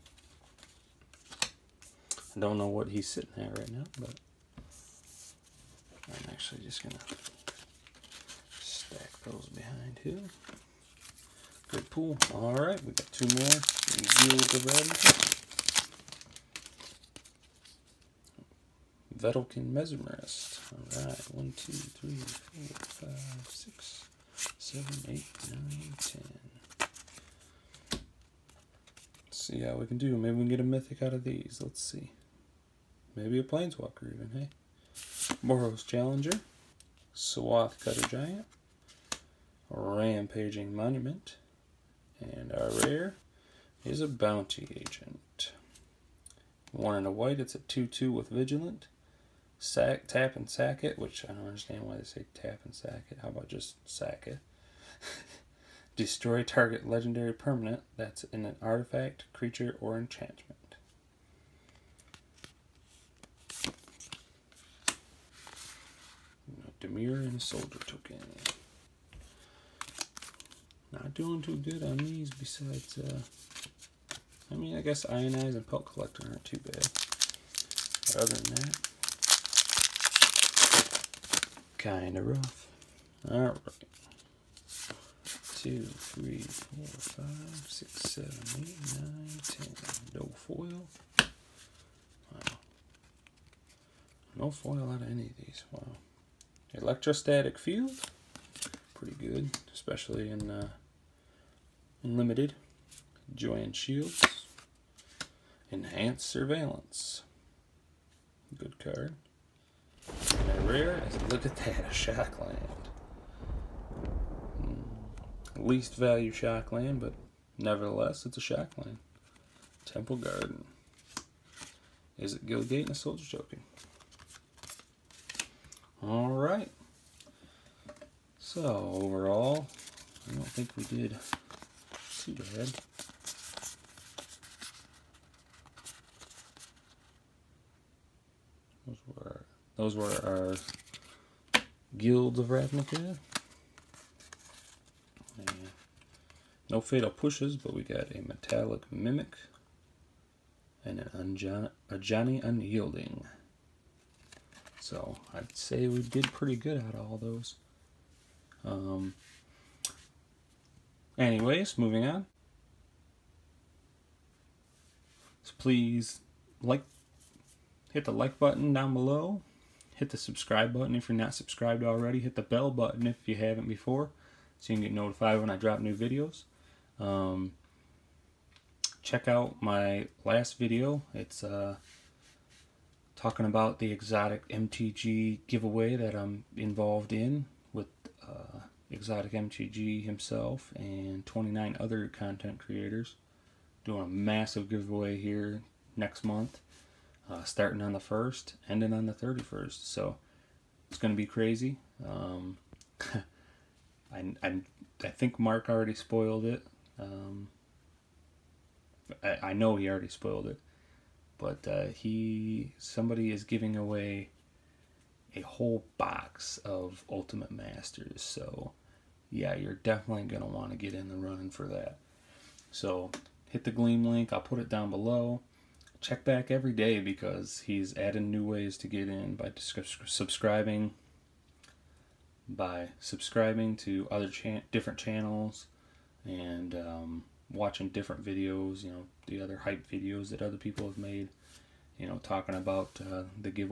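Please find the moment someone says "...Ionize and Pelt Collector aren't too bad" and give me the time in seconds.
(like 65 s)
75 s.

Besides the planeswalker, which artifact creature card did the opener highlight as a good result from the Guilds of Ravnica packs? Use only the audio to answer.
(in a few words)
Metallic Mimic.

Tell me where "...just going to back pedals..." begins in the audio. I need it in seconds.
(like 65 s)
6 s.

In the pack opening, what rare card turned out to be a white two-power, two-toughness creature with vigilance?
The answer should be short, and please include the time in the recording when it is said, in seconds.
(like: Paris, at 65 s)
Bounty Agent, at 44 s.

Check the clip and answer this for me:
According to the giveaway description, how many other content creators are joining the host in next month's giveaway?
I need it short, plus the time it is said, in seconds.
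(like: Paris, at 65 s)
29, at 191 s.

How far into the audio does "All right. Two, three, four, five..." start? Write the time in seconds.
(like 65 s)
83 s.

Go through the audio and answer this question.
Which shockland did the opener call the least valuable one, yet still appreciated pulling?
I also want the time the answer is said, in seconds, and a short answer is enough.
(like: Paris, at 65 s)
Temple Garden, at 119 s.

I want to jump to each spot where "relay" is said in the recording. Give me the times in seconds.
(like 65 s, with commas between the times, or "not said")
not said.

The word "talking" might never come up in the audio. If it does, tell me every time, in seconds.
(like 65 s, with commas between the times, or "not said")
183 s, 242 s.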